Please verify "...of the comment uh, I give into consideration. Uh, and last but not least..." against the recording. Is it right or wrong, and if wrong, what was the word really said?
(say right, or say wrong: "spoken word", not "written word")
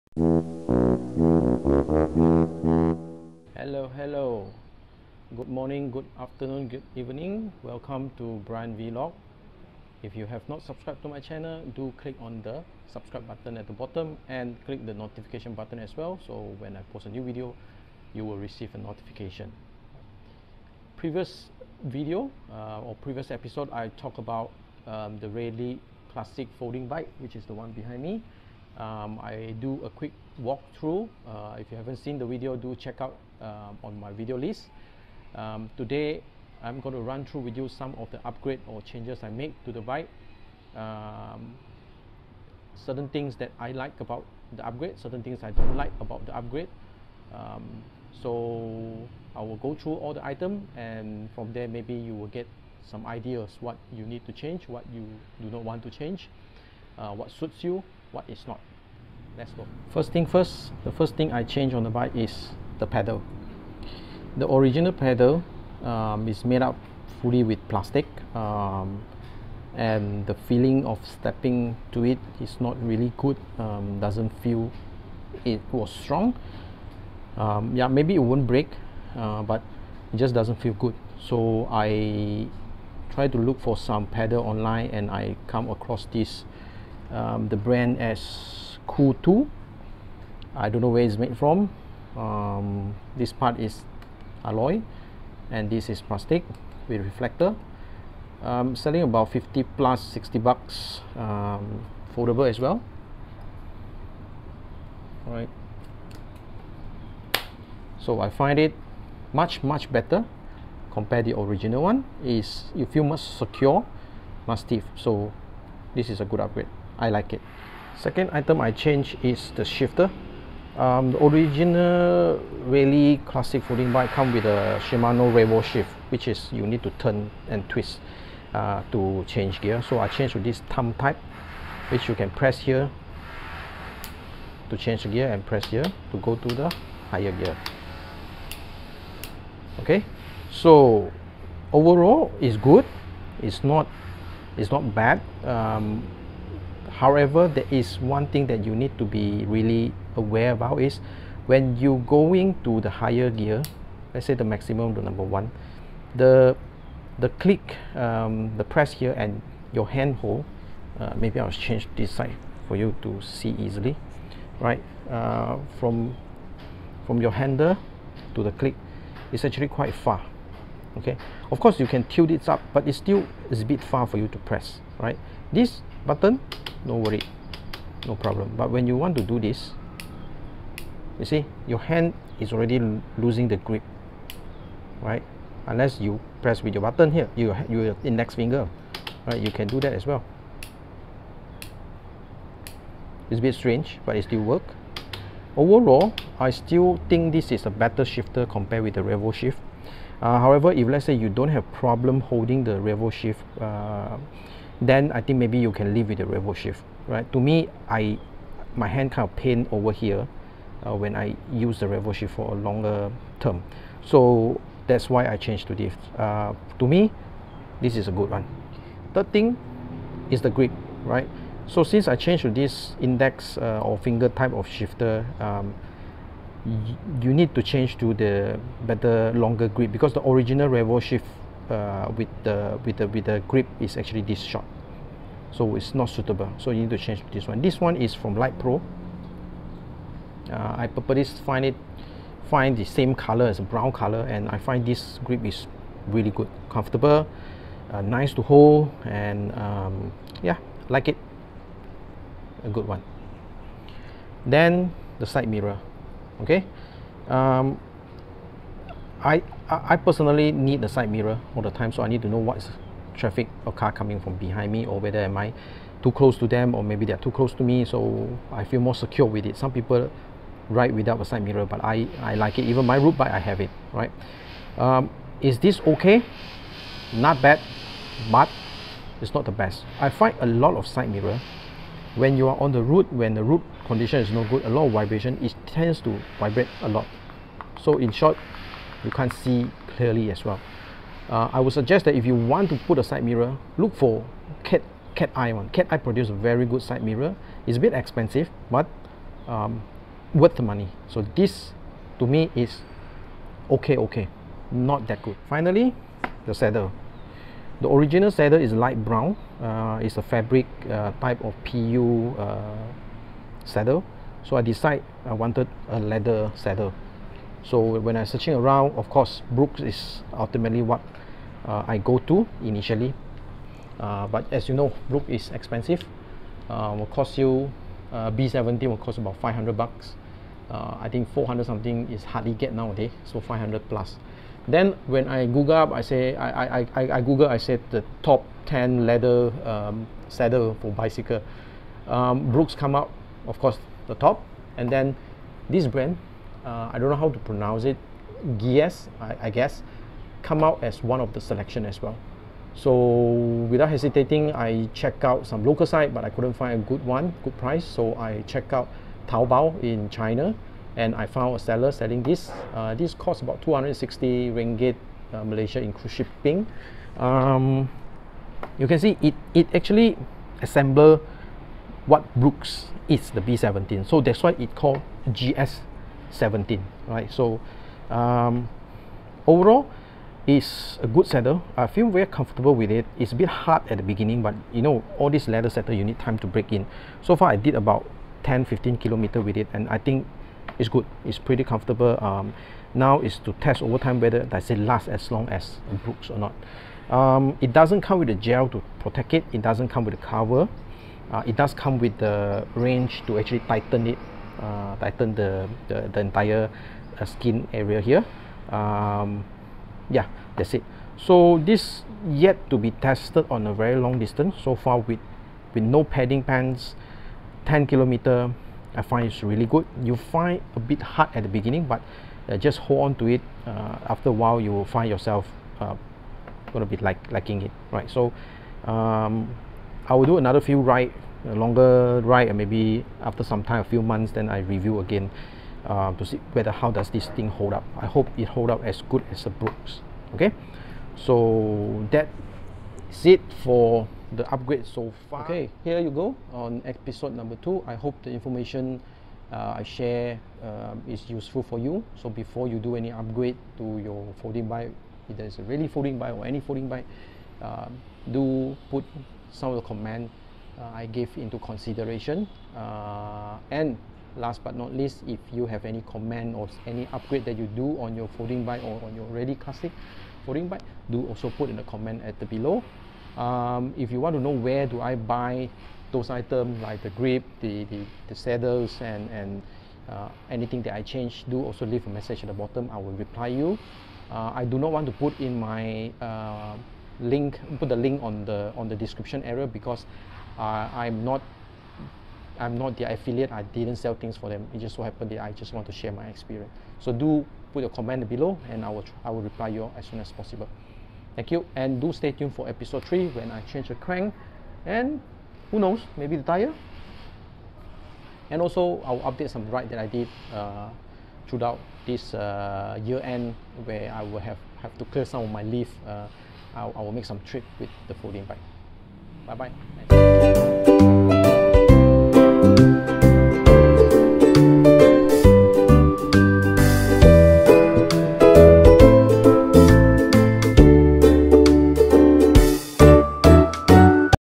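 right.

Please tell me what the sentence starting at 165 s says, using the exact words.
Uh, from from your handle to the click, it's actually quite far, okay?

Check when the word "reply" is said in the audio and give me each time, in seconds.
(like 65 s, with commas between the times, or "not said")
483 s, 499 s.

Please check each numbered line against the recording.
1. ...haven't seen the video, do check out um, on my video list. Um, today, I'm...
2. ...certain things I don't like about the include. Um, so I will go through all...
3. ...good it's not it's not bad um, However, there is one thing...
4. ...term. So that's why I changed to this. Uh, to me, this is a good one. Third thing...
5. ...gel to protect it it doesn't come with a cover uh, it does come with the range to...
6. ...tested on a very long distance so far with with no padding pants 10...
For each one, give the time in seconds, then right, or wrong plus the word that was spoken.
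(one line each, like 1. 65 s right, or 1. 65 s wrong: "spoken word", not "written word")
1. 31 s right
2. 44 s wrong: "upgrade", not "include"
3. 142 s right
4. 213 s right
5. 398 s right
6. 412 s right.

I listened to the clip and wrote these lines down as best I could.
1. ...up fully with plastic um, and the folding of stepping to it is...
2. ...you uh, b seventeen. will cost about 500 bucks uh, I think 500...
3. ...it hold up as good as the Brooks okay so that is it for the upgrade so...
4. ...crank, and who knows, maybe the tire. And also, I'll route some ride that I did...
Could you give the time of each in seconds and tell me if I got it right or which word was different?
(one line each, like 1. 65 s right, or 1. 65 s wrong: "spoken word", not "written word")
1. 66 s wrong: "feeling", not "folding"
2. 327 s wrong: "400", not "500"
3. 438 s right
4. 503 s wrong: "update", not "route".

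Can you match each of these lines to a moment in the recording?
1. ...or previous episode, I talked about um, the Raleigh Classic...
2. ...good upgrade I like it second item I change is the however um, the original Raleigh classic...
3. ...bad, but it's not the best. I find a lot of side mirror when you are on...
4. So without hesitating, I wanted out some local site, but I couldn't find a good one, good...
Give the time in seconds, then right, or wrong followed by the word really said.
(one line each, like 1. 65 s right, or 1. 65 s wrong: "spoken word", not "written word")
1. 22 s right
2. 116 s wrong: "shifter", not "however"
3. 277 s right
4. 352 s wrong: "checked", not "wanted".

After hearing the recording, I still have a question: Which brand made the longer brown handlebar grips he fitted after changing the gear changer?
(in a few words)
Light Pro.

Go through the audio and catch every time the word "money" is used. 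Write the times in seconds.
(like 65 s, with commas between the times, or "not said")
300 s.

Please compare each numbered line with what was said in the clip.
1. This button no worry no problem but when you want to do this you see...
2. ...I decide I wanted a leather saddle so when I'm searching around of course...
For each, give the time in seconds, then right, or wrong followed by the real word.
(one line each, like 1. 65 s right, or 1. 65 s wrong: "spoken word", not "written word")
1. 175 s right
2. 314 s right.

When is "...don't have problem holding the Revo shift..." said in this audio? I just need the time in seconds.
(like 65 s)
201 s.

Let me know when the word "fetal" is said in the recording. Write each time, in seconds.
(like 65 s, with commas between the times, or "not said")
not said.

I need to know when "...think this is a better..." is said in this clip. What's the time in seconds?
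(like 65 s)
197 s.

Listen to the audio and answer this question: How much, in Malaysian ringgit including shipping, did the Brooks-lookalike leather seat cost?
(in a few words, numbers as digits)
260 ringgit.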